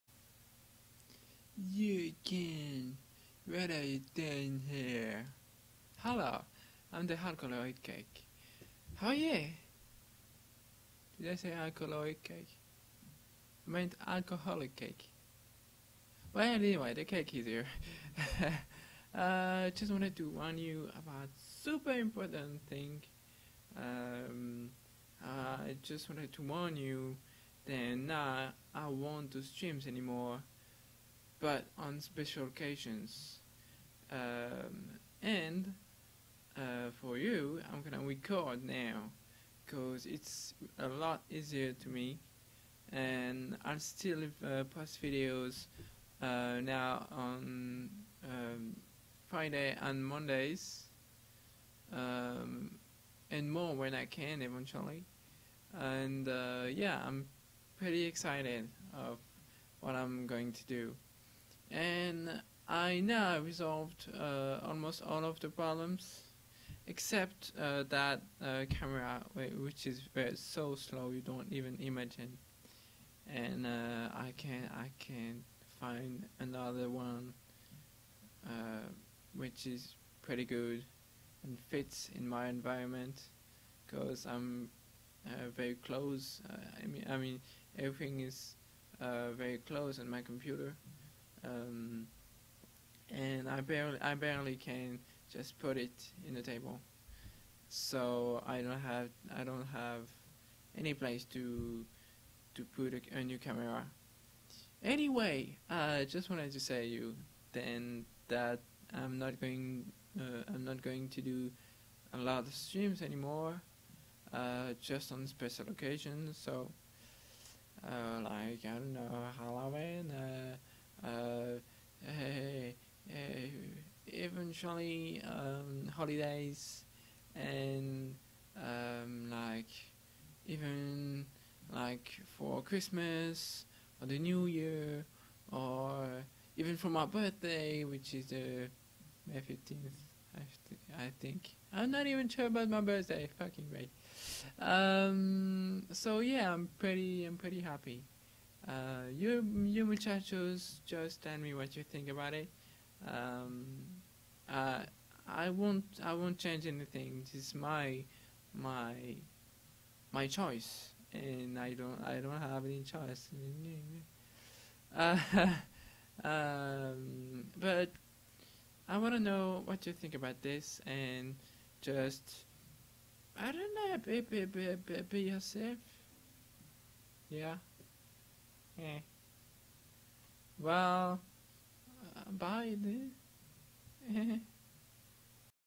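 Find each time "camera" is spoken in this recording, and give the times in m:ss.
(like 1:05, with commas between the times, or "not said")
1:08, 1:43.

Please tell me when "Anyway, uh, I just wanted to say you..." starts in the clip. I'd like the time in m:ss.
1:44.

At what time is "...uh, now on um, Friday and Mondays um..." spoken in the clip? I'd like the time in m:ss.
0:46.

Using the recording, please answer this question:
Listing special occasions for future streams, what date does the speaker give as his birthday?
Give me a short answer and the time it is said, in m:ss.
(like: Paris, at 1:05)
May 15, at 2:19.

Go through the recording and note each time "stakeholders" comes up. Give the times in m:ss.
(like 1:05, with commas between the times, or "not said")
not said.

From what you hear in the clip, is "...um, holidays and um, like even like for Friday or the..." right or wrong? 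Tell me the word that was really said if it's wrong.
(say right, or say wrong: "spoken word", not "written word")
wrong: "Christmas", not "Friday".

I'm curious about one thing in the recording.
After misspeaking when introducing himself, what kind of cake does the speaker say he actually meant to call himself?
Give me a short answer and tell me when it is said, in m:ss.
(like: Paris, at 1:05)
alcoholic cake, at 0:14.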